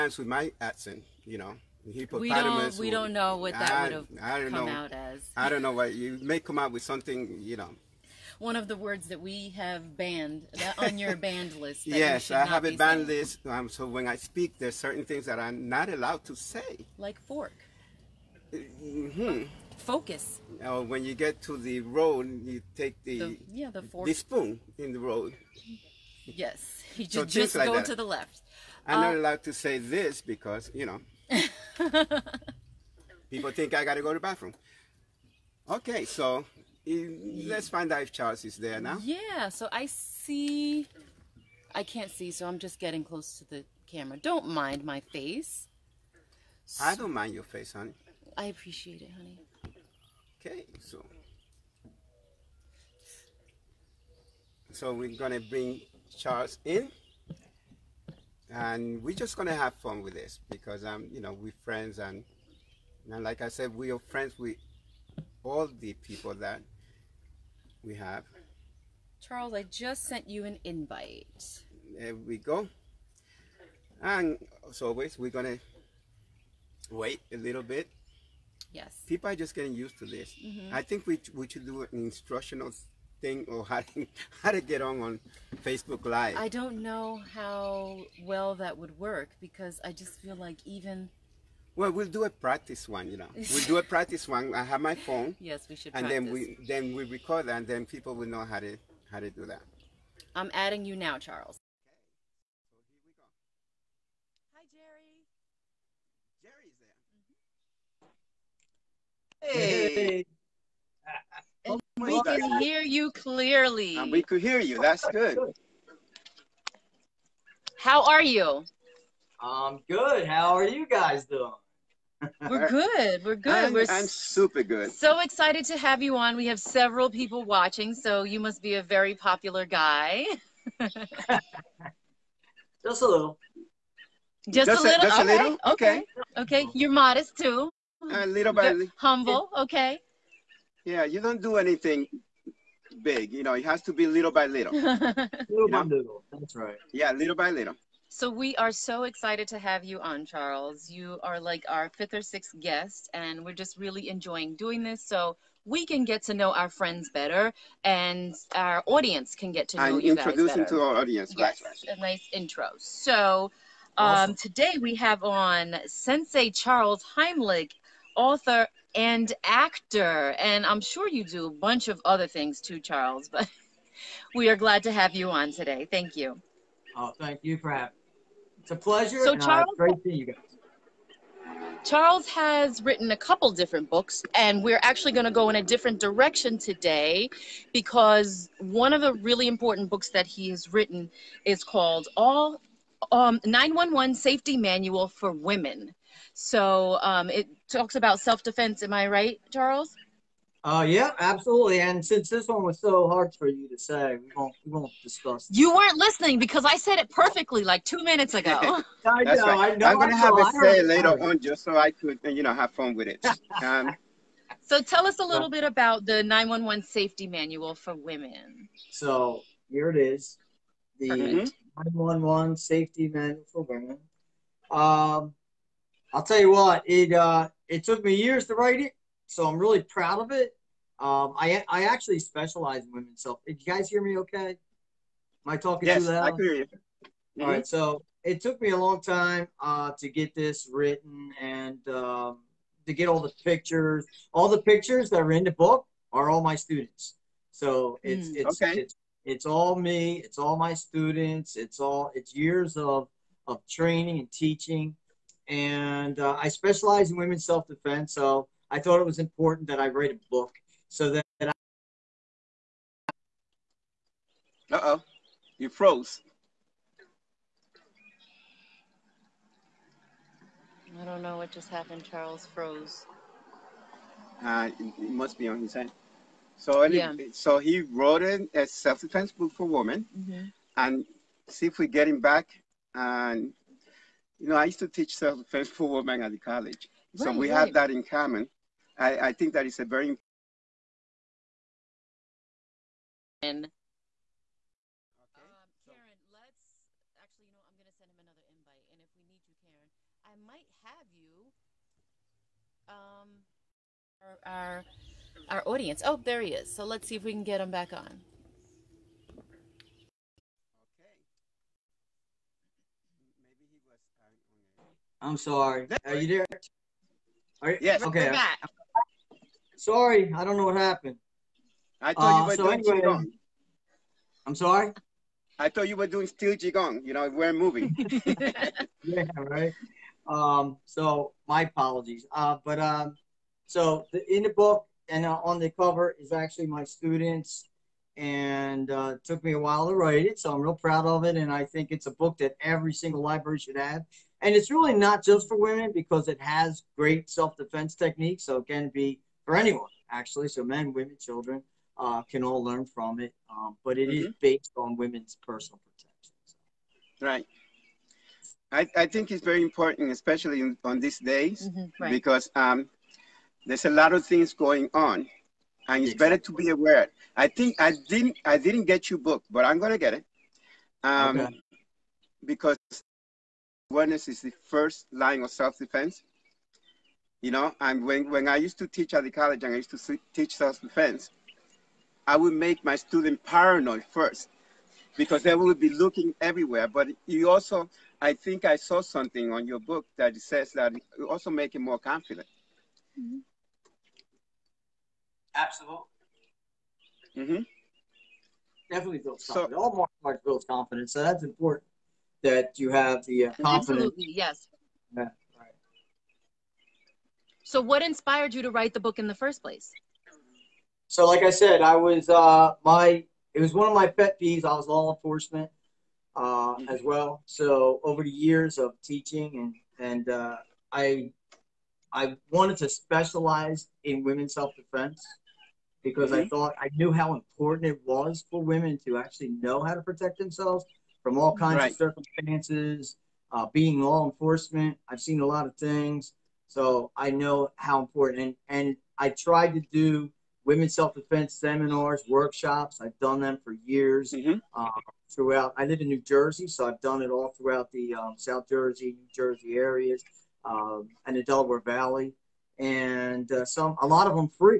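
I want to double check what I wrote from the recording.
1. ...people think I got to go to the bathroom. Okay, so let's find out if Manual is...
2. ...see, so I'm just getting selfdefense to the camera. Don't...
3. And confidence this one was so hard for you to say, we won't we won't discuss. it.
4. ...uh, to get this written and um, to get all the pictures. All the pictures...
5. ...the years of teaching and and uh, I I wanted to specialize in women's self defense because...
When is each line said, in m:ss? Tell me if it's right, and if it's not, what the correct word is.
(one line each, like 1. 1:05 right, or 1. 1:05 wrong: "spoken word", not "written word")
1. 0:33 wrong: "Charles", not "Manual"
2. 0:42 wrong: "close", not "selfdefense"
3. 3:21 wrong: "since", not "confidence"
4. 3:59 right
5. 6:58 right.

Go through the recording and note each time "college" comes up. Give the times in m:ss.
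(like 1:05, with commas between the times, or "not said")
4:46, 6:19.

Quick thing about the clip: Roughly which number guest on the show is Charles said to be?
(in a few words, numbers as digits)
fifth or sixth.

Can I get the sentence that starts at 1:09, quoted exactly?
Charles, I just sent you an invite.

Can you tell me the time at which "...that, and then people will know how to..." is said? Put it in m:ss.
1:37.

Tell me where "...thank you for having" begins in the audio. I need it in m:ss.
2:57.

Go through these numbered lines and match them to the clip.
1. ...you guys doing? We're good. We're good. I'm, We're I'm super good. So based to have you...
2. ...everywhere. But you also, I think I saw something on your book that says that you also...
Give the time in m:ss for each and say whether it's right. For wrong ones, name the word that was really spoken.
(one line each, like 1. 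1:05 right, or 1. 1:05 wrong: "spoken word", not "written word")
1. 2:00 wrong: "excited", not "based"
2. 6:26 right.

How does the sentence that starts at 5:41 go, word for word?
And I think it's a book that every single library should have.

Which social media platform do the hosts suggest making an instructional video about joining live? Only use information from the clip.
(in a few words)
Facebook Live.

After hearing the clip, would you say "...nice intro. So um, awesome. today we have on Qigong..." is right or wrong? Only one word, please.
wrong.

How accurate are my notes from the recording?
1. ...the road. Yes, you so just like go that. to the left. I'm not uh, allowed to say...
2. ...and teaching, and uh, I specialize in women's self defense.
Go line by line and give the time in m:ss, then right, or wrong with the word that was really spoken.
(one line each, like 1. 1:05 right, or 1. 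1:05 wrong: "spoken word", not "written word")
1. 0:24 right
2. 4:14 right.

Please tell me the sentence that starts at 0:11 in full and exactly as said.
yes, I have a banned list.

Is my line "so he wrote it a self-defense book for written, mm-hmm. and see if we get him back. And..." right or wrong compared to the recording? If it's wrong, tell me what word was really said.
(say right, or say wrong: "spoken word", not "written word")
wrong: "women", not "written".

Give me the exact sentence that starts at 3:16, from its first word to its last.
So um, it talks about self defense.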